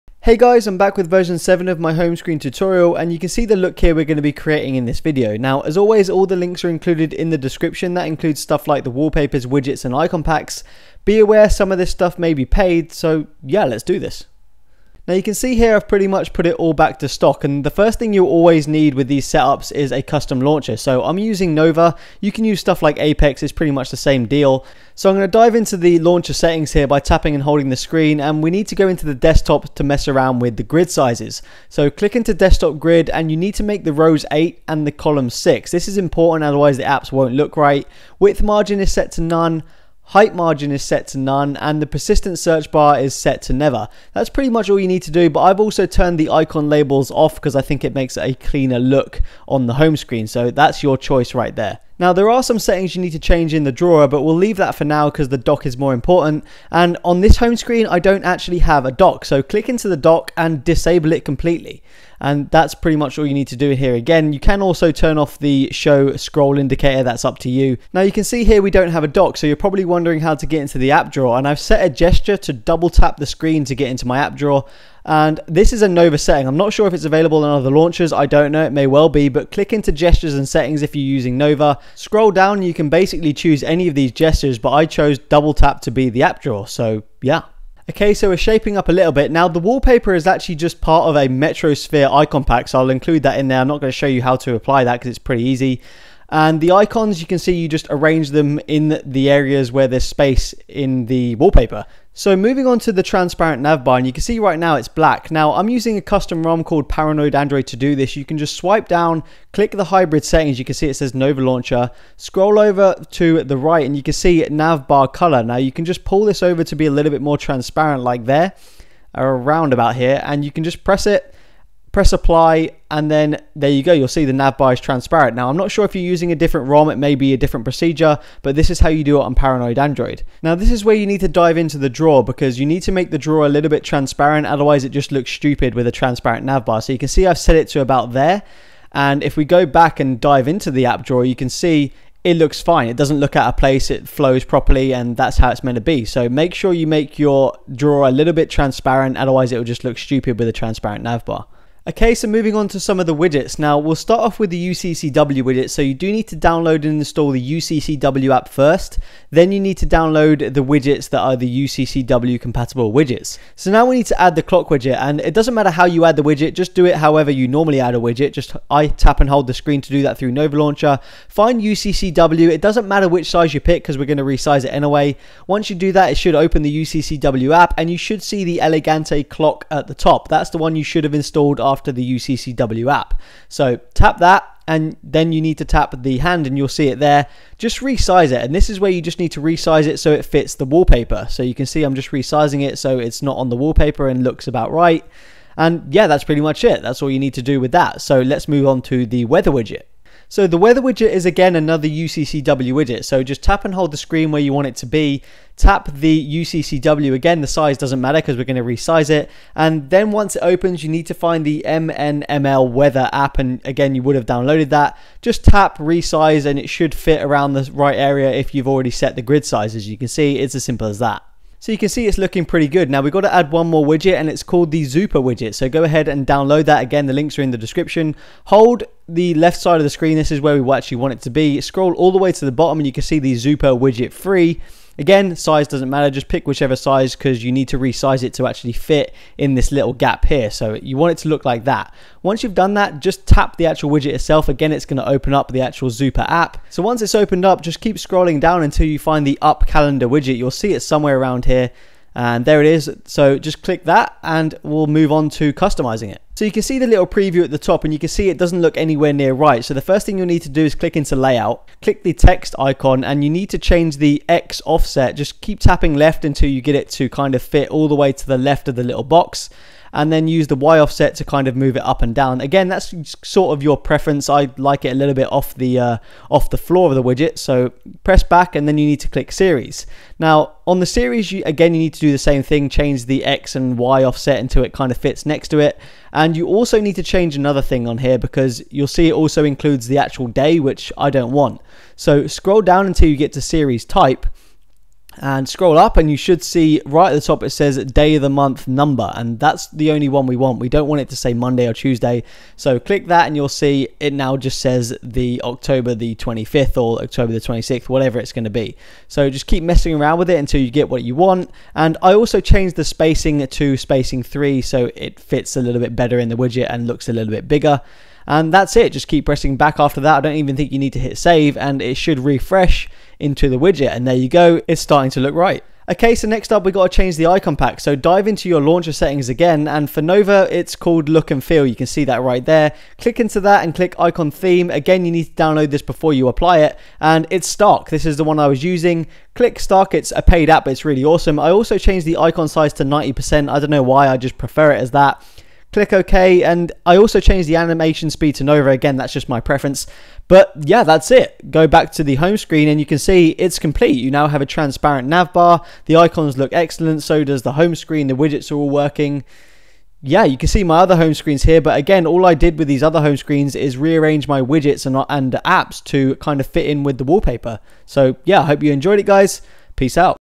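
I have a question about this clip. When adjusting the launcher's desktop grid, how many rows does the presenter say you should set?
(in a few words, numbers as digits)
8.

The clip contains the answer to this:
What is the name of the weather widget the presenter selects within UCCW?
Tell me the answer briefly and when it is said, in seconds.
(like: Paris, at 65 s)
MNML weather, at 211 s.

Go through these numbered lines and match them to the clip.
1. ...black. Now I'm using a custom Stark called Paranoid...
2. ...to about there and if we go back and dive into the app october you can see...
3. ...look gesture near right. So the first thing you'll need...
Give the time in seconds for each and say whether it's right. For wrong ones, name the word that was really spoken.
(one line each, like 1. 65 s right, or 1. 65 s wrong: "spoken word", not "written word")
1. 104 s wrong: "ROM", not "Stark"
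2. 137 s wrong: "drawer", not "october"
3. 258 s wrong: "anywhere", not "gesture".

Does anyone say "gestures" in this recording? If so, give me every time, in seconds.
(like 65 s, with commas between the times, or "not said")
71 s, 79 s, 84 s.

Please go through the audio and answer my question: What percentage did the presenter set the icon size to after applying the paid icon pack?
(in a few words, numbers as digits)
90%.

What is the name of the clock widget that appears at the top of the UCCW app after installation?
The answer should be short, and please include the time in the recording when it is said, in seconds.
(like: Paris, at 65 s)
Elegante, at 178 s.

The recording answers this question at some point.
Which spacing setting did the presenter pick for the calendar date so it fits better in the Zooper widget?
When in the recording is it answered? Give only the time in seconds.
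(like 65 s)
313 s.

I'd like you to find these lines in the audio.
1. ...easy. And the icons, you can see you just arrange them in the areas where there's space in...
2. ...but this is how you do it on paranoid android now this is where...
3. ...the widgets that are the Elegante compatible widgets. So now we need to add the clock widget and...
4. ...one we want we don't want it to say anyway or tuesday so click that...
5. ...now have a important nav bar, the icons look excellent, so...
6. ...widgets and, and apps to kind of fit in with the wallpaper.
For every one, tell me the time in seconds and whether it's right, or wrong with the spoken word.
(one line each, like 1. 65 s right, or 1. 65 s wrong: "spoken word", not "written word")
1. 95 s right
2. 128 s right
3. 160 s wrong: "UCCW", not "Elegante"
4. 300 s wrong: "monday", not "anyway"
5. 354 s wrong: "transparent", not "important"
6. 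364 s right.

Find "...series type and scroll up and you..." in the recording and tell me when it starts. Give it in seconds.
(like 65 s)
293 s.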